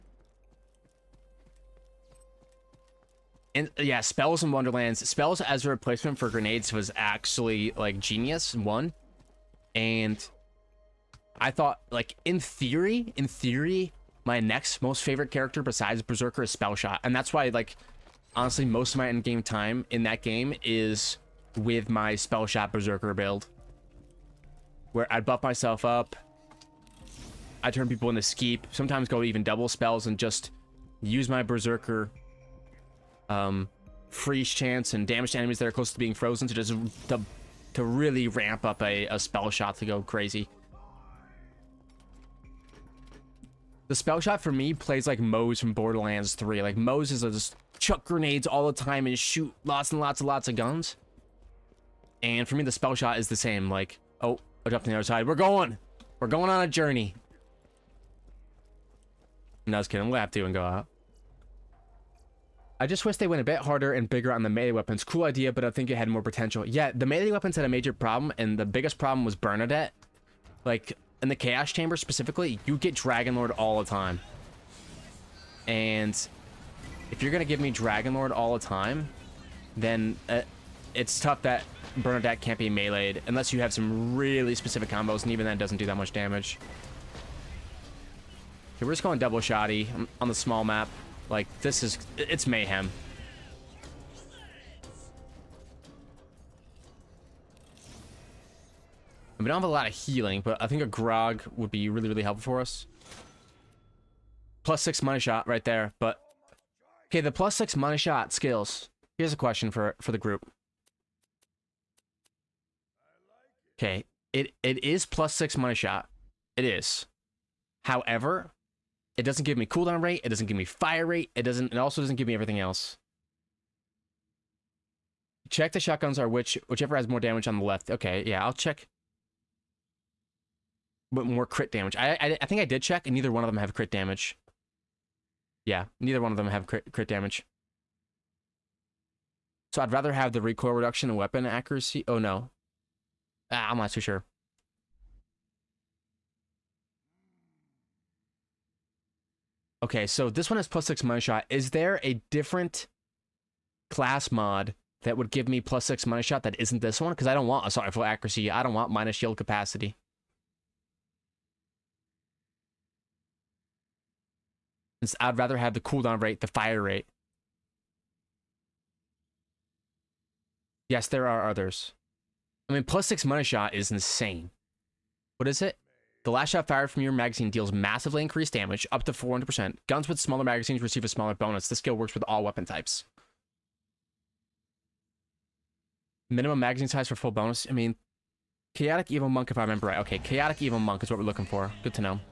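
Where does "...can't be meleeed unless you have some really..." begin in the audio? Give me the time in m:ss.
1:22.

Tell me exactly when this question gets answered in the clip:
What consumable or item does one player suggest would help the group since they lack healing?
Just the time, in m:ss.
1:40.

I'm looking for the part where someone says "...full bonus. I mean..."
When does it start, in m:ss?
3:07.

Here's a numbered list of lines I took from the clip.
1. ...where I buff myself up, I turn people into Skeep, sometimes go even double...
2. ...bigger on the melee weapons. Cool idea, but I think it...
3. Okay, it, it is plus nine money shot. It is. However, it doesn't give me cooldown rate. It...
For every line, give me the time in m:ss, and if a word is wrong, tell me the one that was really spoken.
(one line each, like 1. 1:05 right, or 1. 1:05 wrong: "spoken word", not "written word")
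1. 0:24 right
2. 1:04 right
3. 1:53 wrong: "six", not "nine".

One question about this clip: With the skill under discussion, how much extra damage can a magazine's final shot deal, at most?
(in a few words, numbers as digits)
400%.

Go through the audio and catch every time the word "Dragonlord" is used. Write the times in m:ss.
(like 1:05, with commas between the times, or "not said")
1:12, 1:17.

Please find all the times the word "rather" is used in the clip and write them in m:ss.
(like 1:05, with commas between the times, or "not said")
2:19, 2:45.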